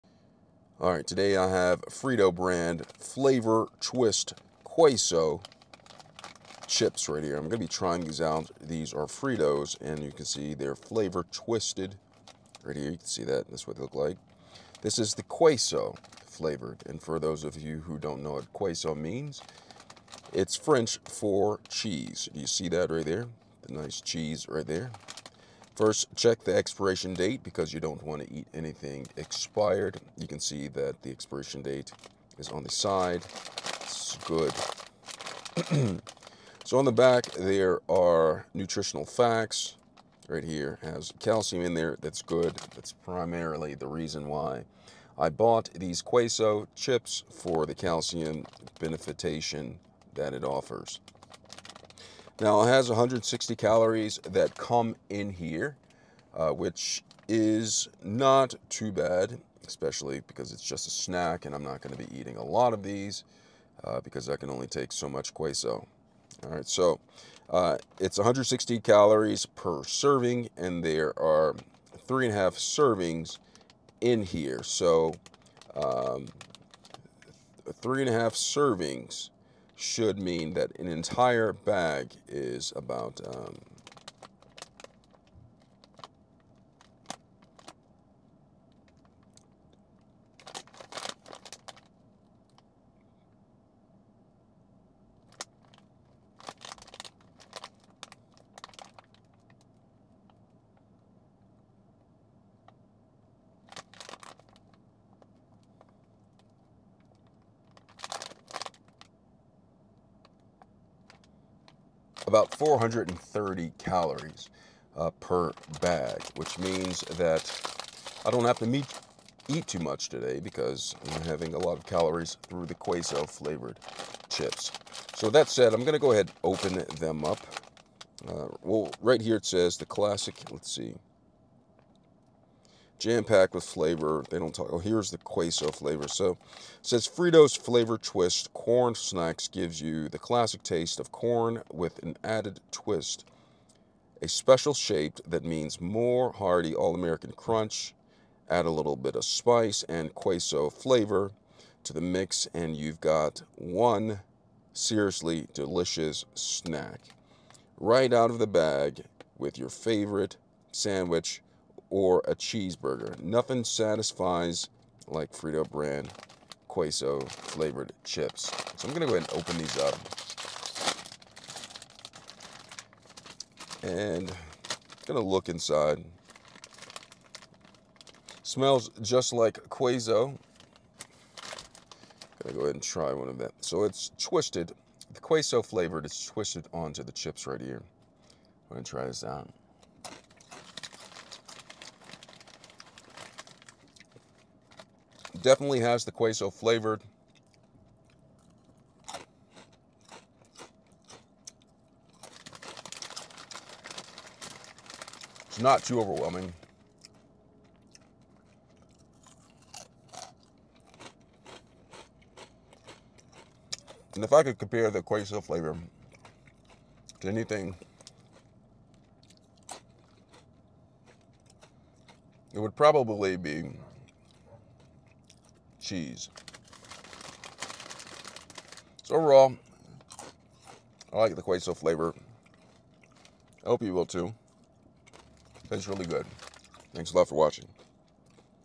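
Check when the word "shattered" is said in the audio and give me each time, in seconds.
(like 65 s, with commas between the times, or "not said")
not said.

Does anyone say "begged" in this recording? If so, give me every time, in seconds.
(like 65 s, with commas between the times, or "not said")
not said.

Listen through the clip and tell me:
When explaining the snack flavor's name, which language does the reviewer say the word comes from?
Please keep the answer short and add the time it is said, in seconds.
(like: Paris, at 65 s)
French, at 20 s.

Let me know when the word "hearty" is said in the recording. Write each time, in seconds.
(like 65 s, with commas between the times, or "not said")
146 s.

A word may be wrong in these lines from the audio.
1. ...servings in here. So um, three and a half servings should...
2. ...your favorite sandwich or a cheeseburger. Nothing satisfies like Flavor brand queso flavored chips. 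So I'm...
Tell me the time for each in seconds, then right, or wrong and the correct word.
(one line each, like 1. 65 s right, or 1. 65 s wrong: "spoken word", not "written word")
1. 72 s right
2. 159 s wrong: "Frito", not "Flavor".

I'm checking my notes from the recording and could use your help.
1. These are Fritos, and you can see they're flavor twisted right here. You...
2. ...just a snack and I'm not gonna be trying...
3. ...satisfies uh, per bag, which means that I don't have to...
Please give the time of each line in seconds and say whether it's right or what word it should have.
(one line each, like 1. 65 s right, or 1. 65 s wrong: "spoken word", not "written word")
1. 8 s right
2. 60 s wrong: "eating", not "trying"
3. 113 s wrong: "calories", not "satisfies".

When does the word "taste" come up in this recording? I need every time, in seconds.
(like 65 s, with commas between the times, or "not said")
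140 s, 235 s.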